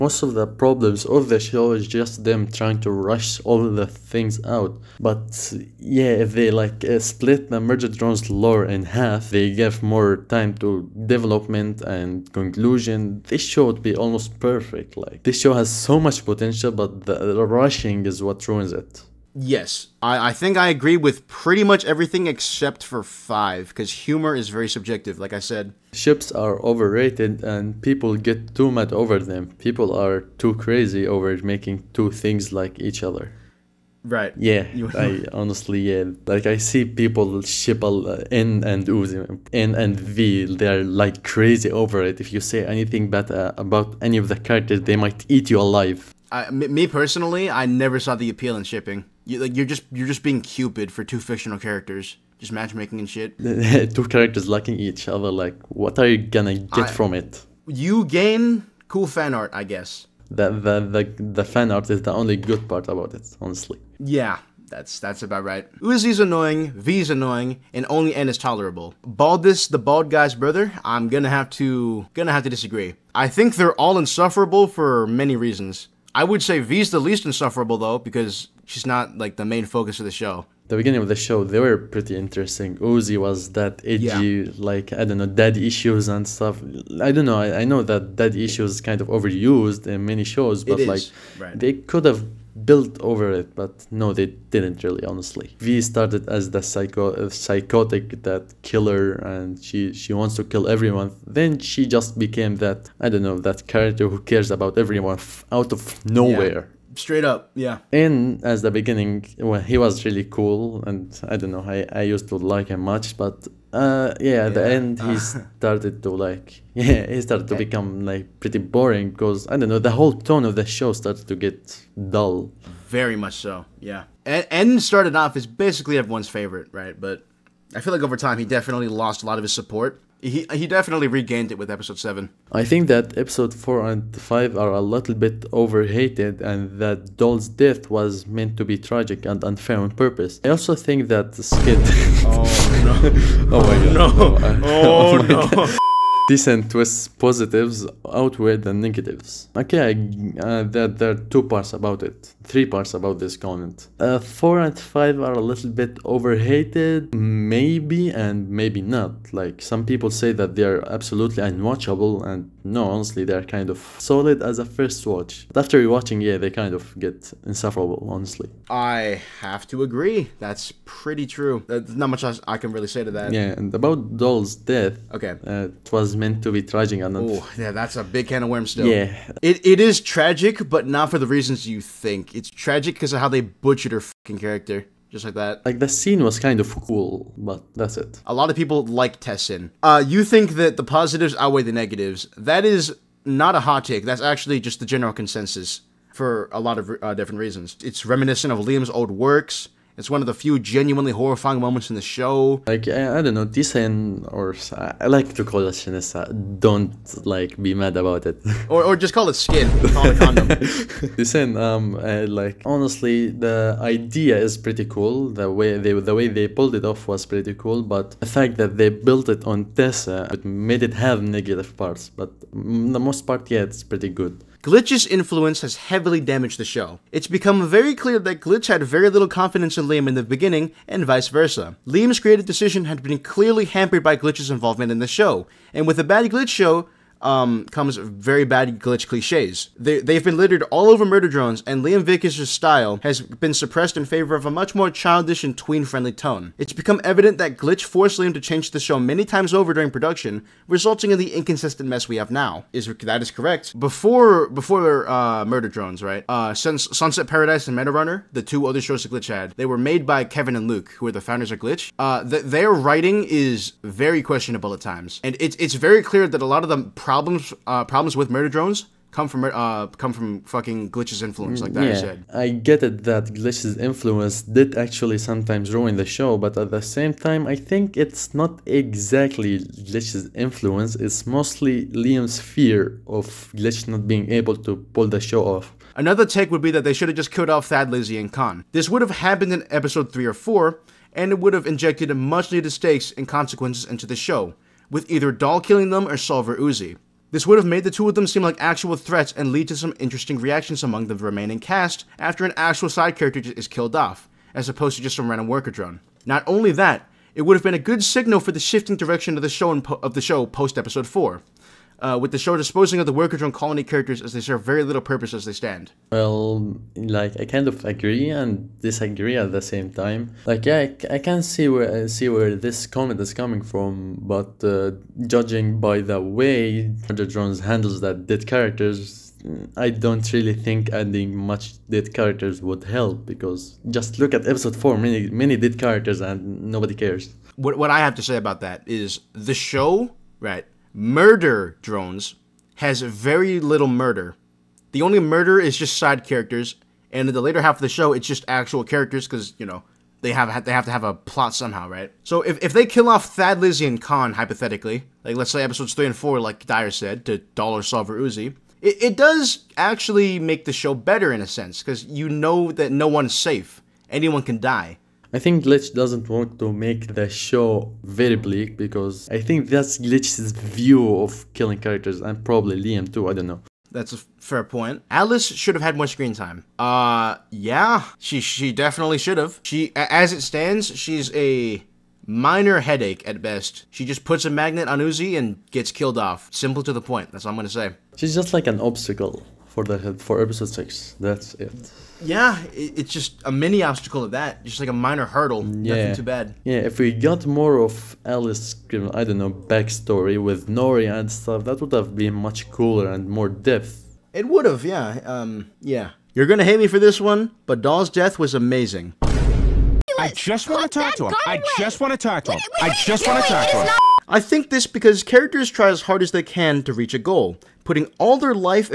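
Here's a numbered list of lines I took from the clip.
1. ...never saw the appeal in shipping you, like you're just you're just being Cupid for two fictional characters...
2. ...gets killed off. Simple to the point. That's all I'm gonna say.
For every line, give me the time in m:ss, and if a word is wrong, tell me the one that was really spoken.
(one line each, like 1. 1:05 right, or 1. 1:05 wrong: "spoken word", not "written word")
1. 0:47 right
2. 6:25 right.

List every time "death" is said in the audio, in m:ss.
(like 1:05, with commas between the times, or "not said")
2:17, 2:54, 6:48.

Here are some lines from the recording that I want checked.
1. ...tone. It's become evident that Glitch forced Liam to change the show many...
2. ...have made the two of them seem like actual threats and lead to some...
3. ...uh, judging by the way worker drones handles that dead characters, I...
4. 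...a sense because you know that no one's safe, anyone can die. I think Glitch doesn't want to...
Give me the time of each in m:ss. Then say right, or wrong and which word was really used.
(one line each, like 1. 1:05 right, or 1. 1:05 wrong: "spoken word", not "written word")
1. 4:06 right
2. 4:57 right
3. 5:24 right
4. 6:01 right.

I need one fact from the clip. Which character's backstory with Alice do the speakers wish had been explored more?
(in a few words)
Nori.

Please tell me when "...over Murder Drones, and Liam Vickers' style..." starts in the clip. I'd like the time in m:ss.
4:00.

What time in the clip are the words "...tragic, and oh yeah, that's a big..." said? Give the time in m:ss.
2:56.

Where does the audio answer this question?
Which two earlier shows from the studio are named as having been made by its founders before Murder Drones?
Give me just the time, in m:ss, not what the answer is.
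4:16.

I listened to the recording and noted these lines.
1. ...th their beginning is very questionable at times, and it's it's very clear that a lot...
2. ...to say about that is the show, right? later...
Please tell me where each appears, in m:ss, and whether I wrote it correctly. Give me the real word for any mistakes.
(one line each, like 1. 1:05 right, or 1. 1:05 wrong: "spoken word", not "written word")
1. 4:22 wrong: "writing", not "beginning"
2. 5:38 wrong: "murder", not "later".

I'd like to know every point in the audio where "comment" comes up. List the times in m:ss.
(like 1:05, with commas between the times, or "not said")
2:33, 5:22.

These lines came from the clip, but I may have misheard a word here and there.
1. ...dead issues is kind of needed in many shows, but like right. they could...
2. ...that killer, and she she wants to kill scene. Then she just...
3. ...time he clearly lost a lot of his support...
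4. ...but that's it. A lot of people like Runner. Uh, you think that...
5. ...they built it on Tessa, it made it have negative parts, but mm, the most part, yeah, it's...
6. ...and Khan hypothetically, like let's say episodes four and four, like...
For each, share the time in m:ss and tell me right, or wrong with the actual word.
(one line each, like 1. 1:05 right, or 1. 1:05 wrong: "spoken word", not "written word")
1. 1:28 wrong: "overused", not "needed"
2. 1:38 wrong: "everyone", not "scene"
3. 2:08 wrong: "definitely", not "clearly"
4. 3:07 wrong: "Tessin", not "Runner"
5. 3:38 right
6. 5:53 wrong: "three", not "four".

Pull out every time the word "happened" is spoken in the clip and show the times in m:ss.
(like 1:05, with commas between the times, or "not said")
4:49.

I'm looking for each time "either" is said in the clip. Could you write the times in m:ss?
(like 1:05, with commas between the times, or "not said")
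4:55.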